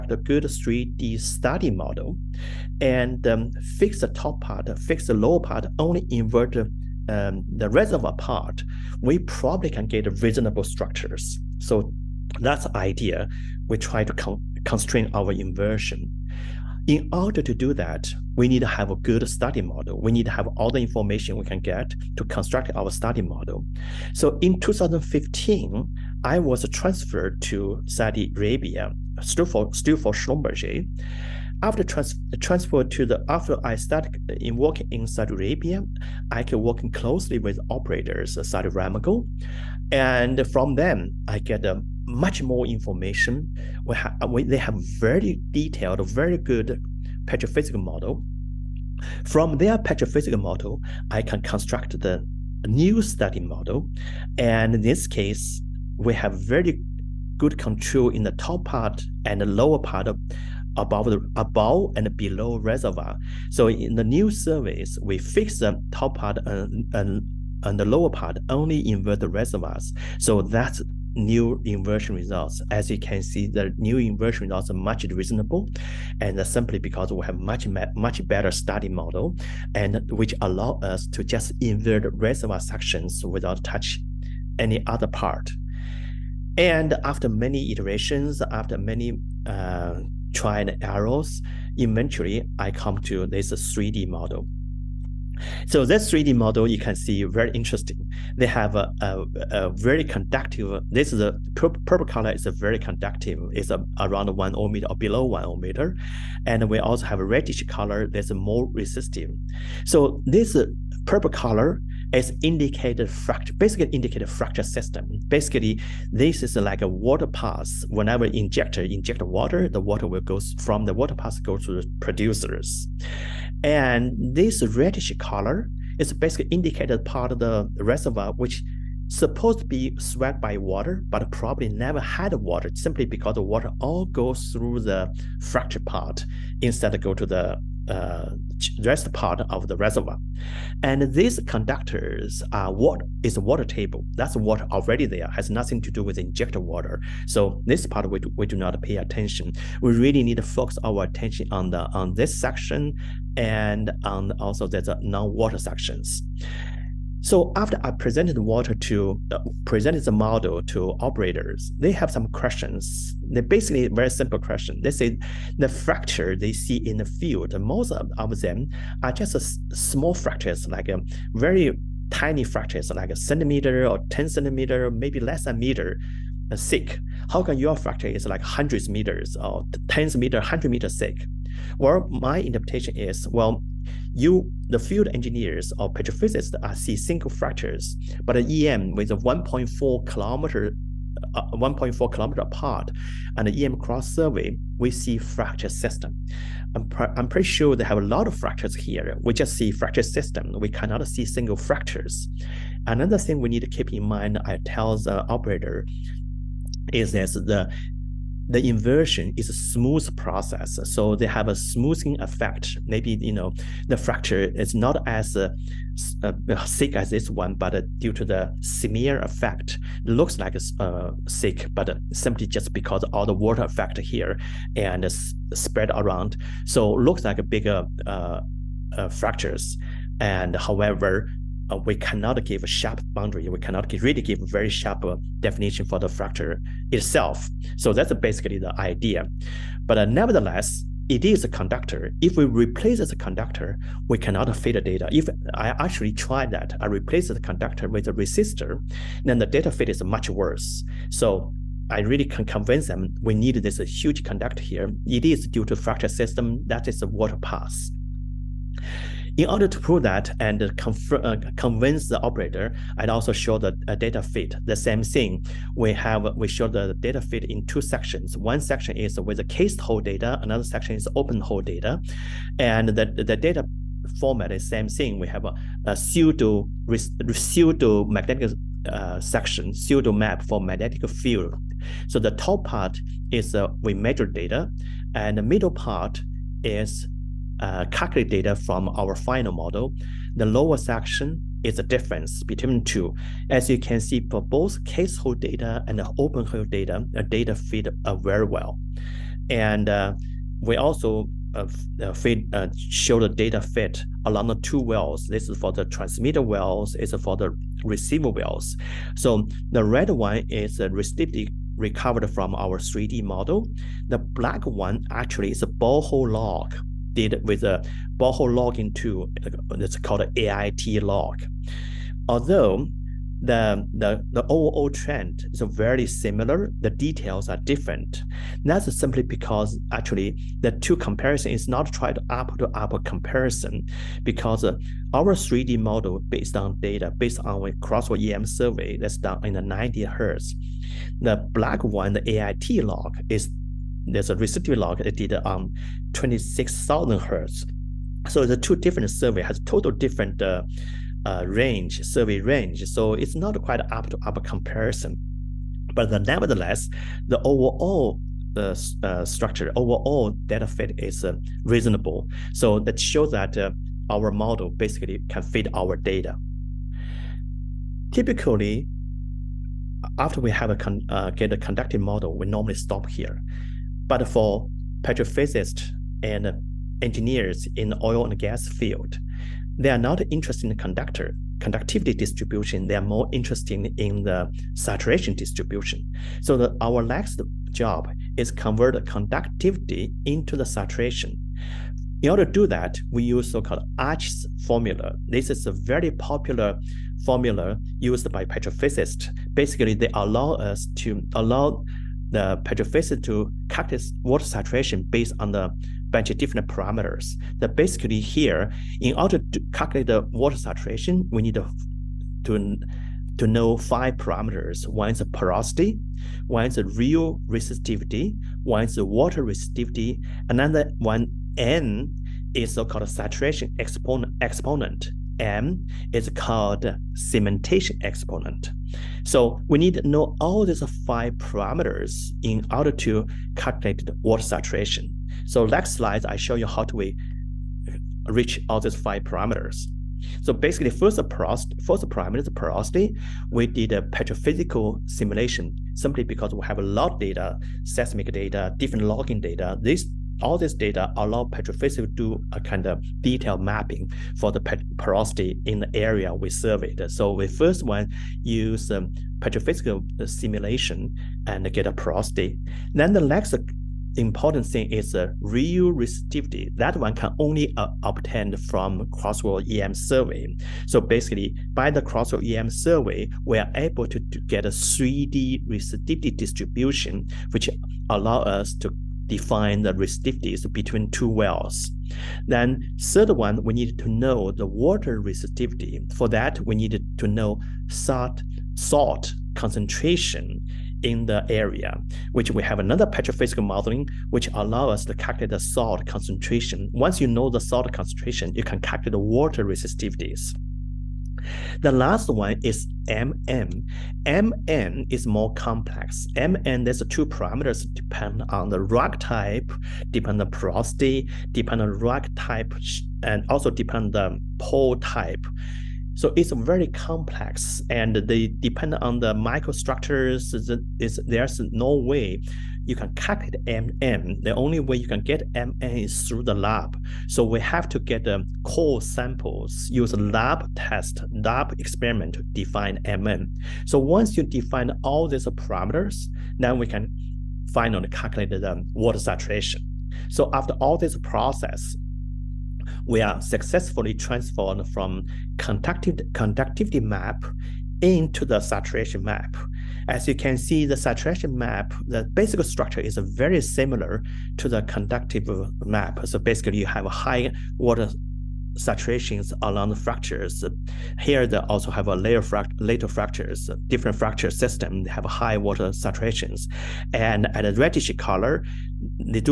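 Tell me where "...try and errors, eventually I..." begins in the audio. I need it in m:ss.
1:30.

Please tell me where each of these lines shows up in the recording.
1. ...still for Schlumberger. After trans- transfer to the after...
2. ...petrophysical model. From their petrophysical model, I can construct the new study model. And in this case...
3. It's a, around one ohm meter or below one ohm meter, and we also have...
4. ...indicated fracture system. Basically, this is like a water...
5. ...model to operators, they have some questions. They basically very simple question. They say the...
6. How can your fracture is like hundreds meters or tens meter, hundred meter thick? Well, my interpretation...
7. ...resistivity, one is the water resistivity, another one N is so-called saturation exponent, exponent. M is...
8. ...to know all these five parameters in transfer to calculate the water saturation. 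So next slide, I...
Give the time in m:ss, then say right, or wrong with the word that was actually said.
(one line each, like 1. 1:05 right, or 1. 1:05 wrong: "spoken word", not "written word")
1. 0:29 right
2. 0:47 right
3. 1:43 right
4. 1:53 right
5. 2:40 right
6. 2:57 right
7. 6:57 right
8. 7:09 wrong: "order", not "transfer".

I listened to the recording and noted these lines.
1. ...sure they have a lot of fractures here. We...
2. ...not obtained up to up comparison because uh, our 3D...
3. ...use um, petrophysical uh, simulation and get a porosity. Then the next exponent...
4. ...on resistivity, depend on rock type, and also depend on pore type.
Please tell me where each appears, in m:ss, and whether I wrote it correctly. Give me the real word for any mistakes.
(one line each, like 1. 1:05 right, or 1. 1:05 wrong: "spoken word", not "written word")
1. 3:17 right
2. 5:31 wrong: "tried", not "obtained"
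3. 7:38 wrong: "important", not "exponent"
4. 8:30 wrong: "porosity", not "resistivity".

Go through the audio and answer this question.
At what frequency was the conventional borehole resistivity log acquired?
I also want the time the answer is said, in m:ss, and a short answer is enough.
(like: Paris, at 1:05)
26,000 hertz, at 5:46.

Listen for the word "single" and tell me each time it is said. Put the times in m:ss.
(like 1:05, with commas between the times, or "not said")
3:06, 3:21.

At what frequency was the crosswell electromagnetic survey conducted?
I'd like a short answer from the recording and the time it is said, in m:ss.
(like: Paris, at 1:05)
90 hertz, at 5:39.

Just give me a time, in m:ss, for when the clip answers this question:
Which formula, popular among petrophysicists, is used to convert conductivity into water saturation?
6:33.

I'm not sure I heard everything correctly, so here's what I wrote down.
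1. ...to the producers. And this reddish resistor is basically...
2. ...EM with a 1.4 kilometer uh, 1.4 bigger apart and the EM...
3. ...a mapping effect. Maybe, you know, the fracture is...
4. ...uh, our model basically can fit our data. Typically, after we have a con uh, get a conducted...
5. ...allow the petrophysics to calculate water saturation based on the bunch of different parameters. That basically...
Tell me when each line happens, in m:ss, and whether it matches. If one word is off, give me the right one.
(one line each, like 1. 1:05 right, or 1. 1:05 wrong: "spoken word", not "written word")
1. 2:01 wrong: "color", not "resistor"
2. 3:08 wrong: "kilometer", not "bigger"
3. 3:31 wrong: "smoothing", not "mapping"
4. 6:03 right
5. 6:41 right.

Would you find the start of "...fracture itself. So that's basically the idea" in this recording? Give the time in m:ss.
3:56.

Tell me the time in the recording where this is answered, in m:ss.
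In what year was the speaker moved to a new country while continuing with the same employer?
0:24.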